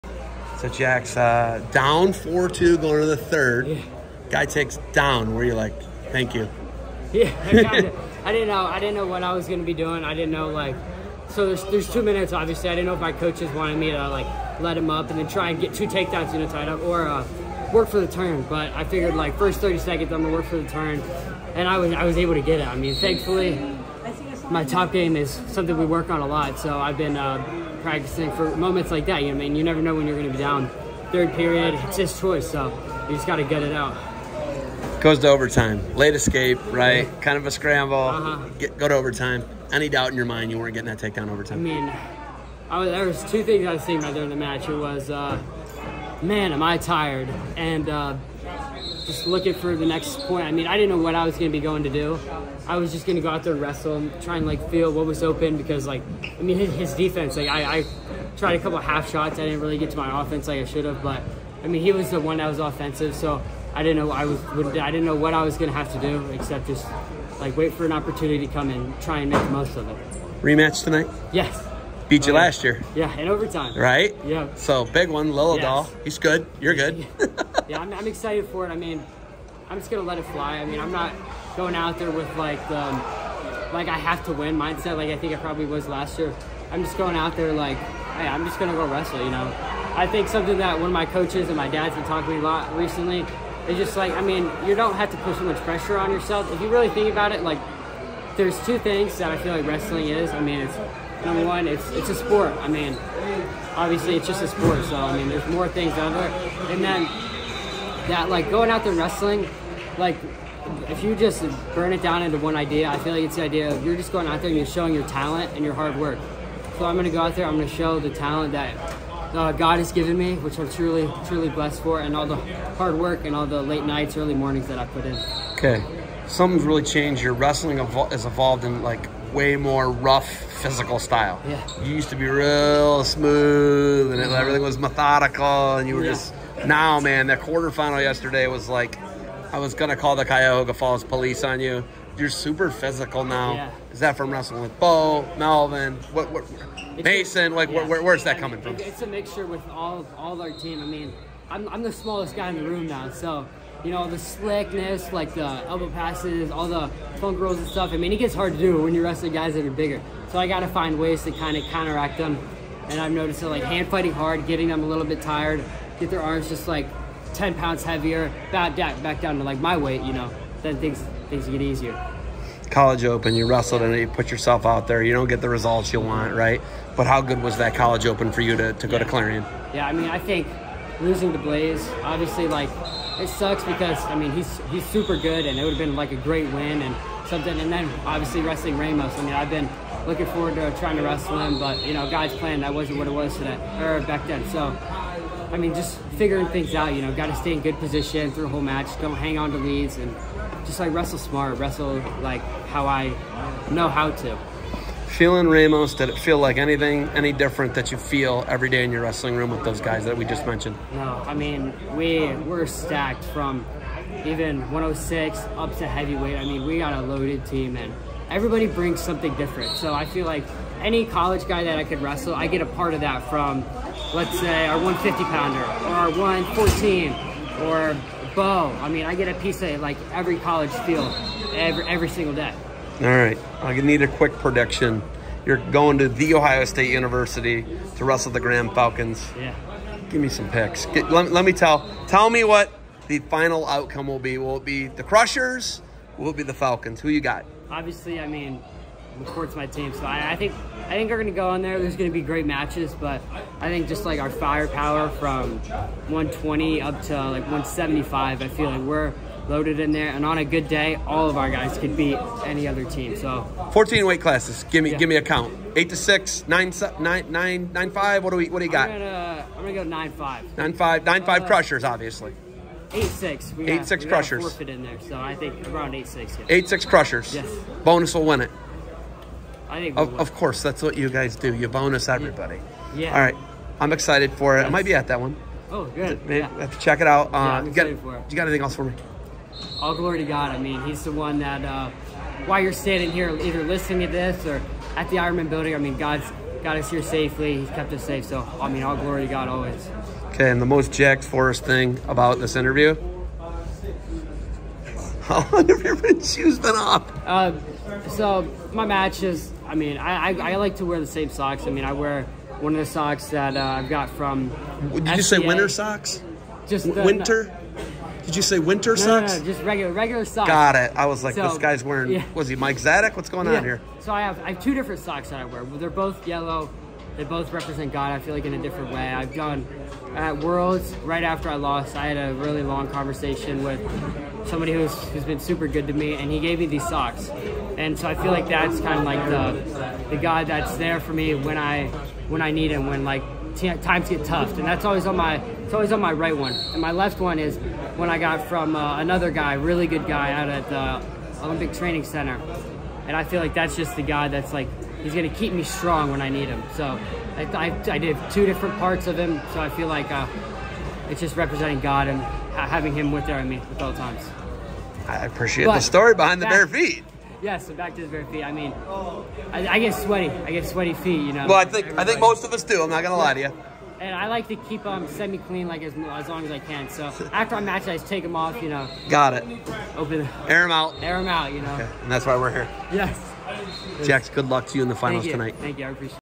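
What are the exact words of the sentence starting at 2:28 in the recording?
It's a mixture with all all our team.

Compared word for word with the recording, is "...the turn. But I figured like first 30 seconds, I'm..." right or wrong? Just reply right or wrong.
right.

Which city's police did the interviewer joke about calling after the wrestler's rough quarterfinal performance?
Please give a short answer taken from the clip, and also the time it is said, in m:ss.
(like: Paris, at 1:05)
Cuyahoga Falls, at 2:20.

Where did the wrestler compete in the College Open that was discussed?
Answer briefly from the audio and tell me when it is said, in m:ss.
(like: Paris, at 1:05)
Clarion, at 2:59.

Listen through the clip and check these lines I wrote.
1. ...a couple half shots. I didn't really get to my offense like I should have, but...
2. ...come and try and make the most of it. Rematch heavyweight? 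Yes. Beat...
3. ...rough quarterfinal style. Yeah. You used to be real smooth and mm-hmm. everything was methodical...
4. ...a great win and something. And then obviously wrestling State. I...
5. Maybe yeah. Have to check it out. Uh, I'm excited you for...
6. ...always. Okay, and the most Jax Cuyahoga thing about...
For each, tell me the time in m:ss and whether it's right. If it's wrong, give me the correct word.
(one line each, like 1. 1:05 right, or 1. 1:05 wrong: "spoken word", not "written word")
1. 0:58 right
2. 1:08 wrong: "tonight", not "heavyweight"
3. 2:09 wrong: "physical", not "quarterfinal"
4. 3:06 wrong: "Ramos", not "State"
5. 4:46 right
6. 4:59 wrong: "Forrest", not "Cuyahoga".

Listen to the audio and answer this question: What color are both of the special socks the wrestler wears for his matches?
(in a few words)
Yellow.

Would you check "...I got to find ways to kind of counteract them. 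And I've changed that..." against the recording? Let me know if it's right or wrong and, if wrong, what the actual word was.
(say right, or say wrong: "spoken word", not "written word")
wrong: "noticed", not "changed".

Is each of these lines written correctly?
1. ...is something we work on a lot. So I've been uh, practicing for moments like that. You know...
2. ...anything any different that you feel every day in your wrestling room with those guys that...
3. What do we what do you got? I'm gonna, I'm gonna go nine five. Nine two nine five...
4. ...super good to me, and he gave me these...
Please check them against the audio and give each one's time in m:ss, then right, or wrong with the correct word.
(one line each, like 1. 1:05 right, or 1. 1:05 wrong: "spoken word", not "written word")
1. 0:25 right
2. 3:26 right
3. 4:28 wrong: "five", not "two"
4. 5:35 right.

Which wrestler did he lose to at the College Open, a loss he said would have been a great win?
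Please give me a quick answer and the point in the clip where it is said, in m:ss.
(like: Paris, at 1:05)
Blaze, at 3:01.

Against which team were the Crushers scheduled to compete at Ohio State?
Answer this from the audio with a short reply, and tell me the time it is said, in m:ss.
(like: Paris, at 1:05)
Graham Falcons, at 3:58.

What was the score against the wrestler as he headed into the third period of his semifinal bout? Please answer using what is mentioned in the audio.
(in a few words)
4-2.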